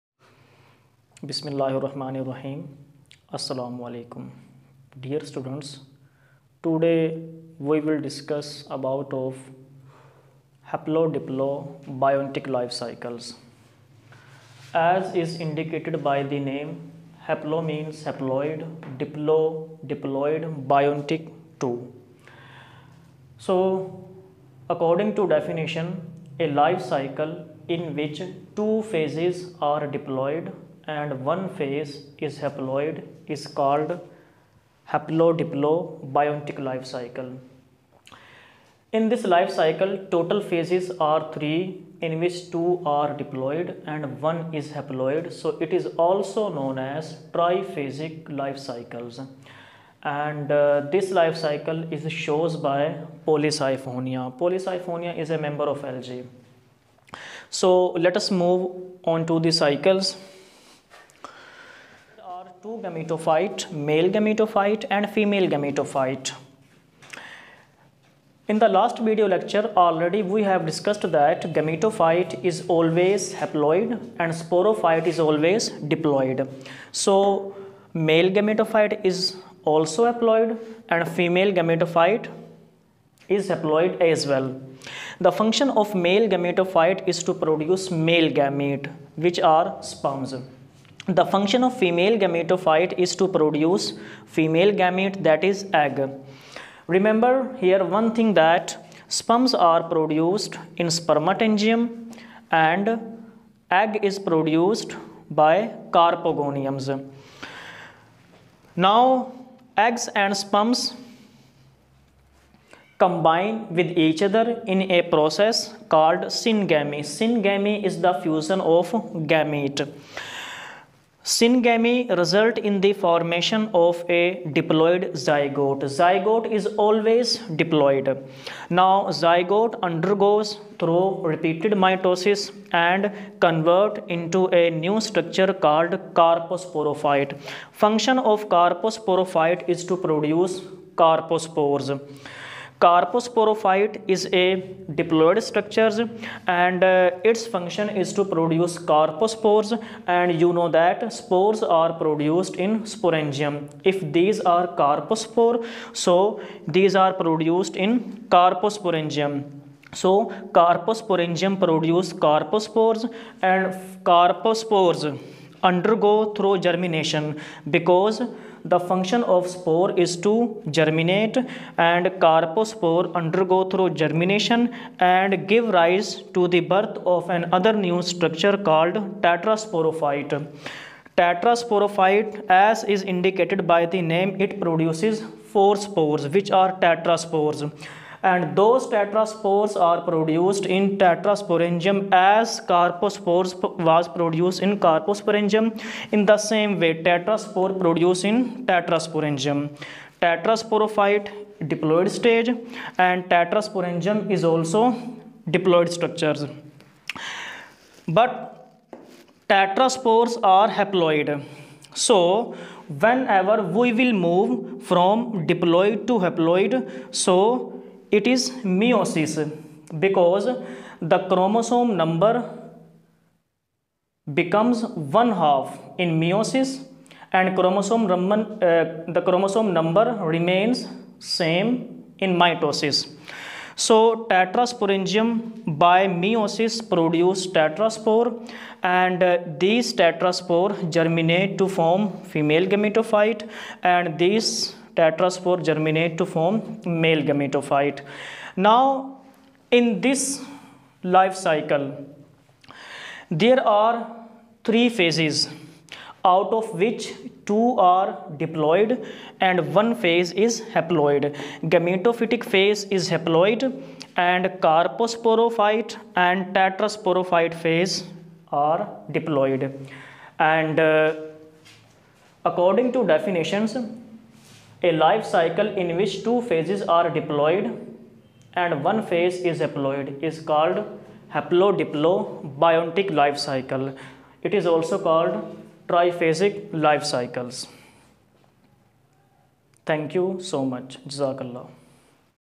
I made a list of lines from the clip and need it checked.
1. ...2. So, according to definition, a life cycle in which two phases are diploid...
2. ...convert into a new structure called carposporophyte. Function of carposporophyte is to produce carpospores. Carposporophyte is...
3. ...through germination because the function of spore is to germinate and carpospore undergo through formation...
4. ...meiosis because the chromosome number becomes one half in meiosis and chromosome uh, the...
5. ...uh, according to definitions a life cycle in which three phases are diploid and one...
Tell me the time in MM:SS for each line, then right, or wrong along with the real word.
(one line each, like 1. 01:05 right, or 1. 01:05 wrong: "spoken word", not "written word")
1. 00:21 right
2. 02:13 right
3. 02:46 wrong: "germination", not "formation"
4. 03:38 right
5. 04:30 wrong: "two", not "three".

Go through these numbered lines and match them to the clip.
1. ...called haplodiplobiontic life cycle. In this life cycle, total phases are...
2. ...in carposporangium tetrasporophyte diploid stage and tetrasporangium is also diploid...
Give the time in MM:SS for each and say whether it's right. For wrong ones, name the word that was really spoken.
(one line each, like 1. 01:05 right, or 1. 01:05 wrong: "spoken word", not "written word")
1. 00:33 right
2. 03:18 wrong: "tetrasporangium", not "carposporangium".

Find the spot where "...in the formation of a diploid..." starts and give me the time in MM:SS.
02:02.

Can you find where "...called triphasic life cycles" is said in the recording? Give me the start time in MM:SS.
04:44.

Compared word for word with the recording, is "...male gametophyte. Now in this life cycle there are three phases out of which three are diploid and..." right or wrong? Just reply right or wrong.
wrong.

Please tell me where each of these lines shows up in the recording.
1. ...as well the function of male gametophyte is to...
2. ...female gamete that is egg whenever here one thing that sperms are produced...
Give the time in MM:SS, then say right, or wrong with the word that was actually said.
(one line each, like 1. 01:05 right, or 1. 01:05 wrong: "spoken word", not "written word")
1. 01:24 right
2. 01:34 wrong: "remember", not "whenever".